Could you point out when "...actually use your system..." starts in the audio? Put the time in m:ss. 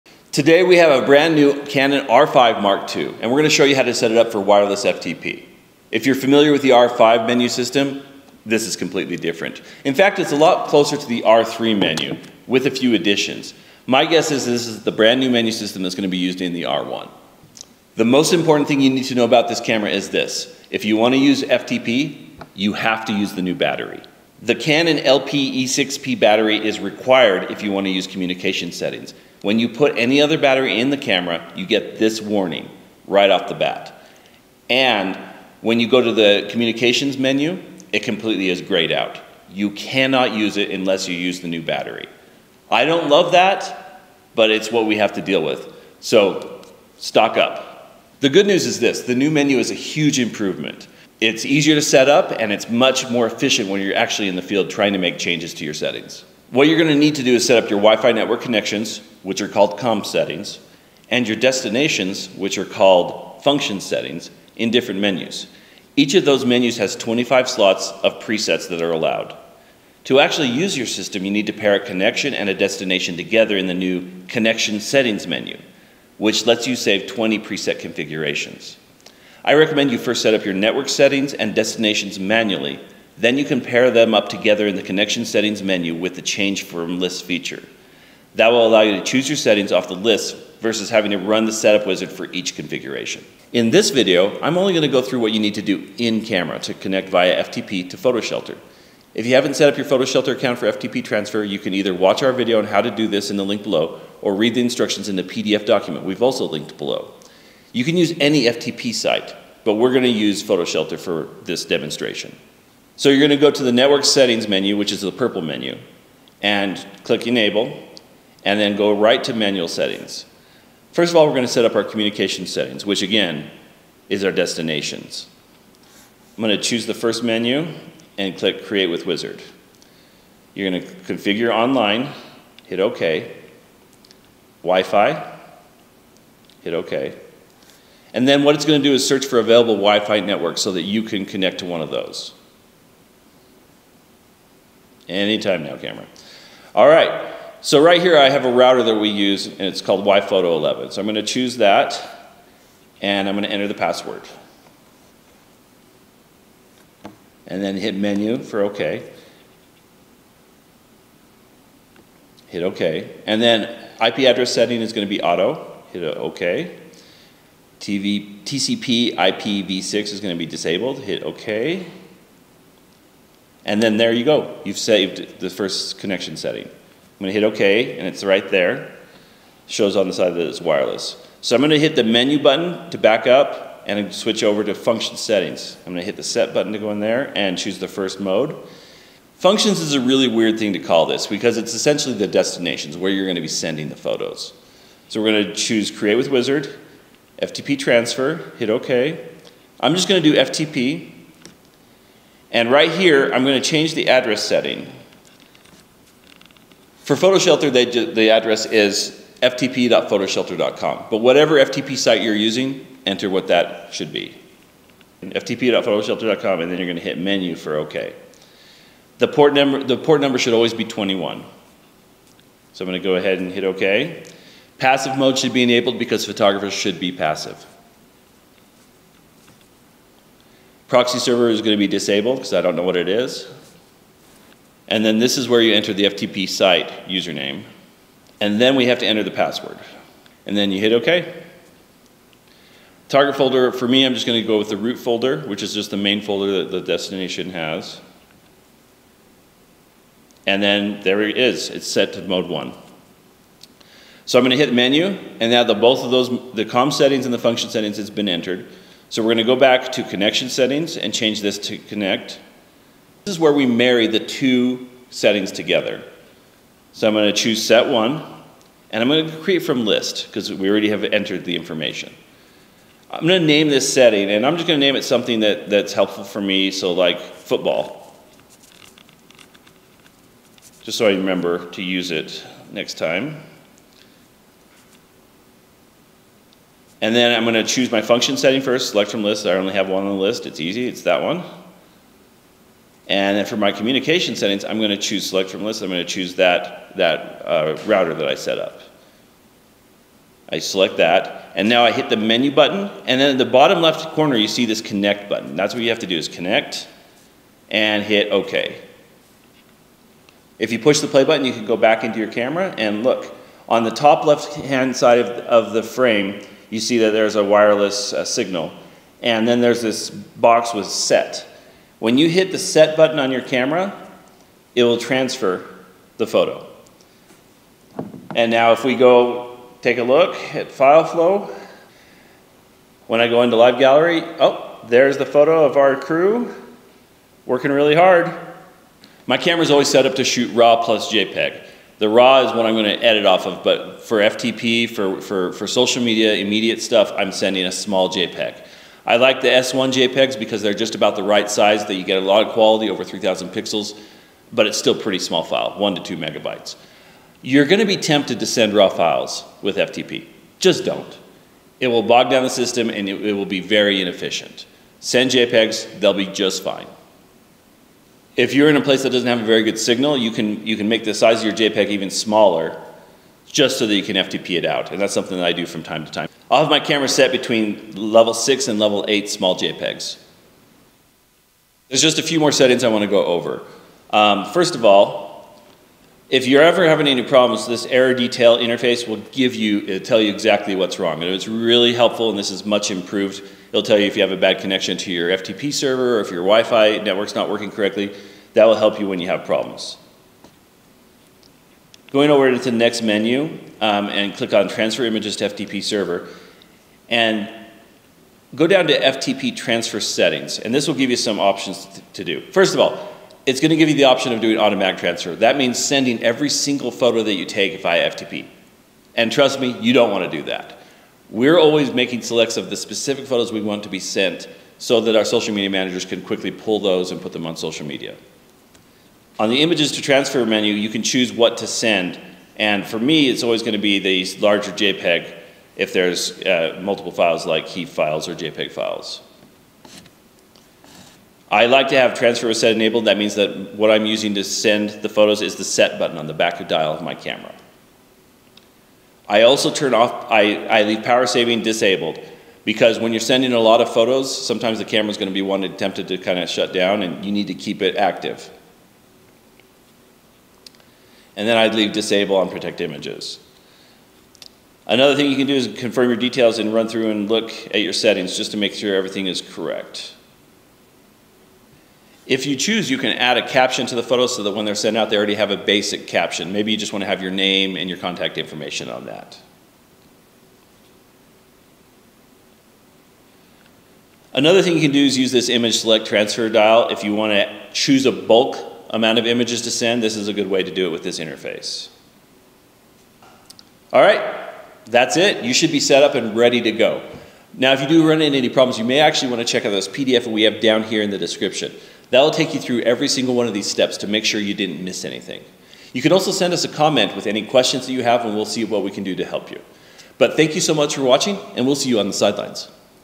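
1:10.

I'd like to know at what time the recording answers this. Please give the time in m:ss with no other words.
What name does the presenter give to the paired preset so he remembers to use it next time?
4:37.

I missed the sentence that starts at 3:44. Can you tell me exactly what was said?
Passive mode should be enabled because photographers should be passive.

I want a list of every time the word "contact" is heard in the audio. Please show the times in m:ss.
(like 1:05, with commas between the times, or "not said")
7:57.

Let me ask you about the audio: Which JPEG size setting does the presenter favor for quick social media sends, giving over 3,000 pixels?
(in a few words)
S1.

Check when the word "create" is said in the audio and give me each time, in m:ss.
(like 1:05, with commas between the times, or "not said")
2:08, 3:15, 4:29.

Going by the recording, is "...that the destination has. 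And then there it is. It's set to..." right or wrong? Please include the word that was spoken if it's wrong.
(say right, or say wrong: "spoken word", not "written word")
right.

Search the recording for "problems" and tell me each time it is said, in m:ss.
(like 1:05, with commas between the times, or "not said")
6:27, 6:39, 8:18.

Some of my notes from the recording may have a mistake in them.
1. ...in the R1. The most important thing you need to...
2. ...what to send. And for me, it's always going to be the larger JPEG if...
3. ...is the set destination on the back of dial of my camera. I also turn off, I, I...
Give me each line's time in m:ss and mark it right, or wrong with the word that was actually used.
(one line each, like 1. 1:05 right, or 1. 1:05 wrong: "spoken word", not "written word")
1. 0:16 right
2. 7:11 right
3. 7:25 wrong: "button", not "destination".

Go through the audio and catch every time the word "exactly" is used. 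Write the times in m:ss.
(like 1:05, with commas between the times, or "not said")
6:30.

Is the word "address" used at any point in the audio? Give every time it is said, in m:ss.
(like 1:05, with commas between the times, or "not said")
2:44, 3:24, 3:28.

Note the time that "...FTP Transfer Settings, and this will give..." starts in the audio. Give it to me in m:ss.
6:48.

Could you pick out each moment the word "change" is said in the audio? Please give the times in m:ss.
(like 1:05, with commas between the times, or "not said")
0:55, 1:26, 3:23, 4:21.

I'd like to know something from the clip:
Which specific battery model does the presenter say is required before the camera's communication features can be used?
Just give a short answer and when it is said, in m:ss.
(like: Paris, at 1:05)
Canon LP E6P, at 0:24.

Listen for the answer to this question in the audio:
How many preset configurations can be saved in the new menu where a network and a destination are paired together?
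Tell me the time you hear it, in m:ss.
1:17.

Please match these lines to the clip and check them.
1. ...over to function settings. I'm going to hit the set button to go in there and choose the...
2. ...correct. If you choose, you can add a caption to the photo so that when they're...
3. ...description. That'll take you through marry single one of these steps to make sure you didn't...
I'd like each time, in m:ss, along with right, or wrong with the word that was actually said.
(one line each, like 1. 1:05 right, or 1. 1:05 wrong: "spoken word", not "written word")
1. 3:04 right
2. 7:49 right
3. 8:21 wrong: "every", not "marry".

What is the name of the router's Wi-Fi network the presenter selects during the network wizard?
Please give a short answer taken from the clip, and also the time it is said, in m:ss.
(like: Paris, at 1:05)
Wi-Fi YPhoto 11, at 2:30.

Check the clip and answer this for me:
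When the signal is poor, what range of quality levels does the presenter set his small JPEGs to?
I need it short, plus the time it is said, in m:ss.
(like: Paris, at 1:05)
level 6 to level 8, at 6:17.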